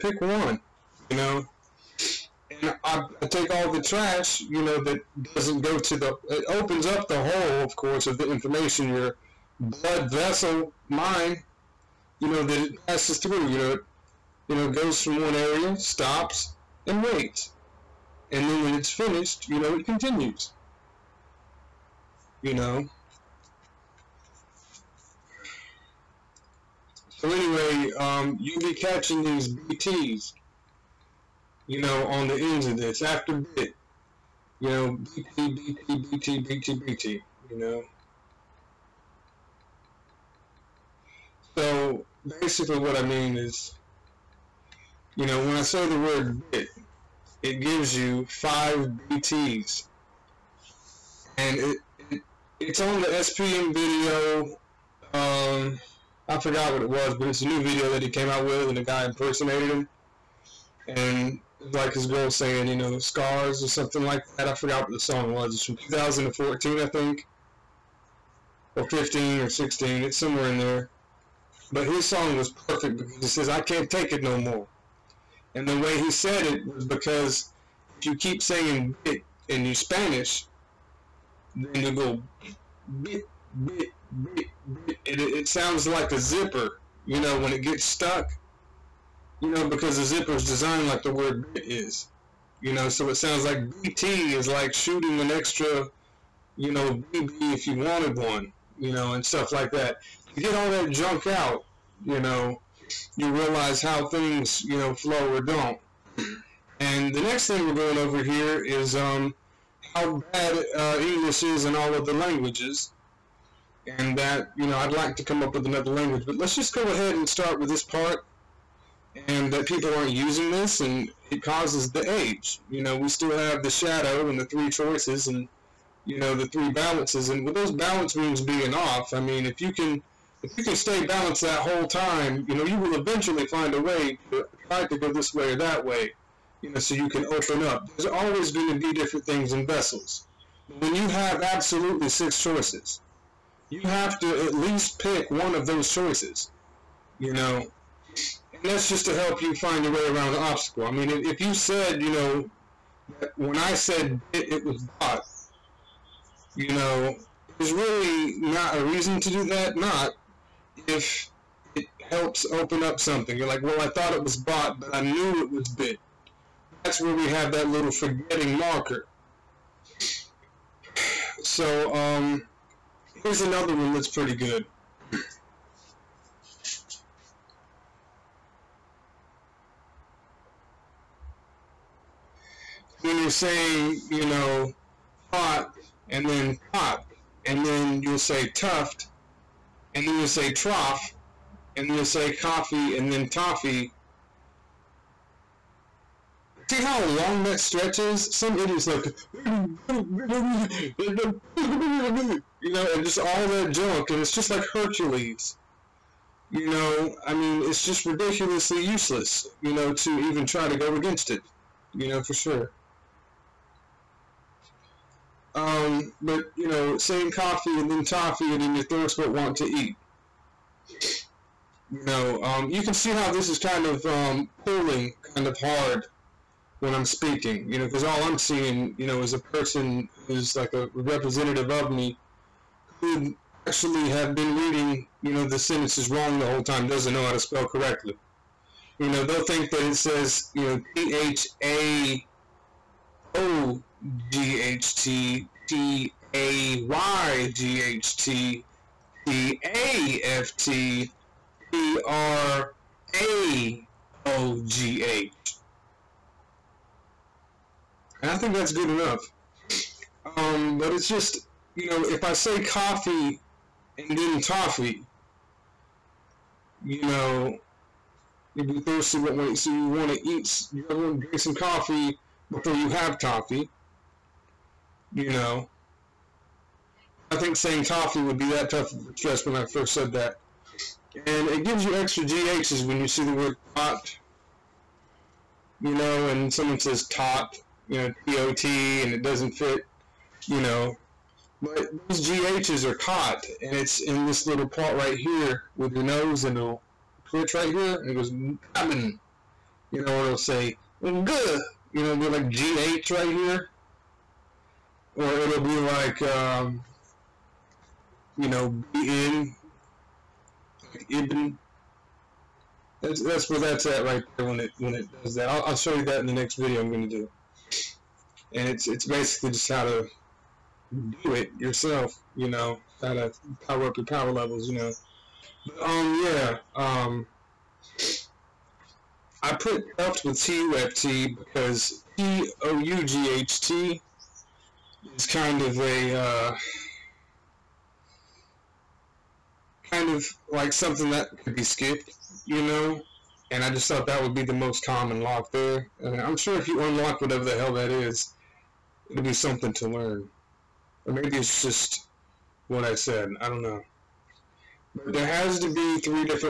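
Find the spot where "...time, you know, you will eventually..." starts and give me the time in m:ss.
2:11.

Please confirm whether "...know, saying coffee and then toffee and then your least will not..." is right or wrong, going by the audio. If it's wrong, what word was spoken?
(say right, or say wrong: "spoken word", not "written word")
wrong: "thirst", not "least".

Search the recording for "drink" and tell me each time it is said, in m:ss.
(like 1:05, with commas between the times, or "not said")
4:31.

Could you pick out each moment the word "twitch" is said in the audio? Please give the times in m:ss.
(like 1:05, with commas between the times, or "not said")
4:57.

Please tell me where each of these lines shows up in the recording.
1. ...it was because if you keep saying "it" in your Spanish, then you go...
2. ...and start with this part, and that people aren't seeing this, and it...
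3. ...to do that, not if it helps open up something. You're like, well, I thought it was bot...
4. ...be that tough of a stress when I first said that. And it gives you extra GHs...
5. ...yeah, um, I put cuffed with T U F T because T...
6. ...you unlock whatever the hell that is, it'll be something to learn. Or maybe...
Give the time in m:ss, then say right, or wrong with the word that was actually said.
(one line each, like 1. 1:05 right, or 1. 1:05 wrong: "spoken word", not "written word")
1. 1:16 right
2. 1:57 wrong: "using", not "seeing"
3. 2:39 right
4. 4:38 right
5. 5:26 right
6. 5:46 right.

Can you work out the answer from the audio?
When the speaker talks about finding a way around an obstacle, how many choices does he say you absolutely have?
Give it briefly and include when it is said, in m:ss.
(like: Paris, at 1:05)
6, at 2:22.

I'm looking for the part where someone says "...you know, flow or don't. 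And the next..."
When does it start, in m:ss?
1:44.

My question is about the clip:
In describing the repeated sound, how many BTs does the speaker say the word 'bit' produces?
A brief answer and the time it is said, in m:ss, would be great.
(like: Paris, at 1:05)
5, at 0:48.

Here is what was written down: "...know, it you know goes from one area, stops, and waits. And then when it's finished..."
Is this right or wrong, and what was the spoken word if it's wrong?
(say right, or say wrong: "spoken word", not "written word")
right.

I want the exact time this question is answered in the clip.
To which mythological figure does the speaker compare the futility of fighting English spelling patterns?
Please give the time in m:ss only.
3:24.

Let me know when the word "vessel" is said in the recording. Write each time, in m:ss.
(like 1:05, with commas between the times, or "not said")
0:10, 2:19.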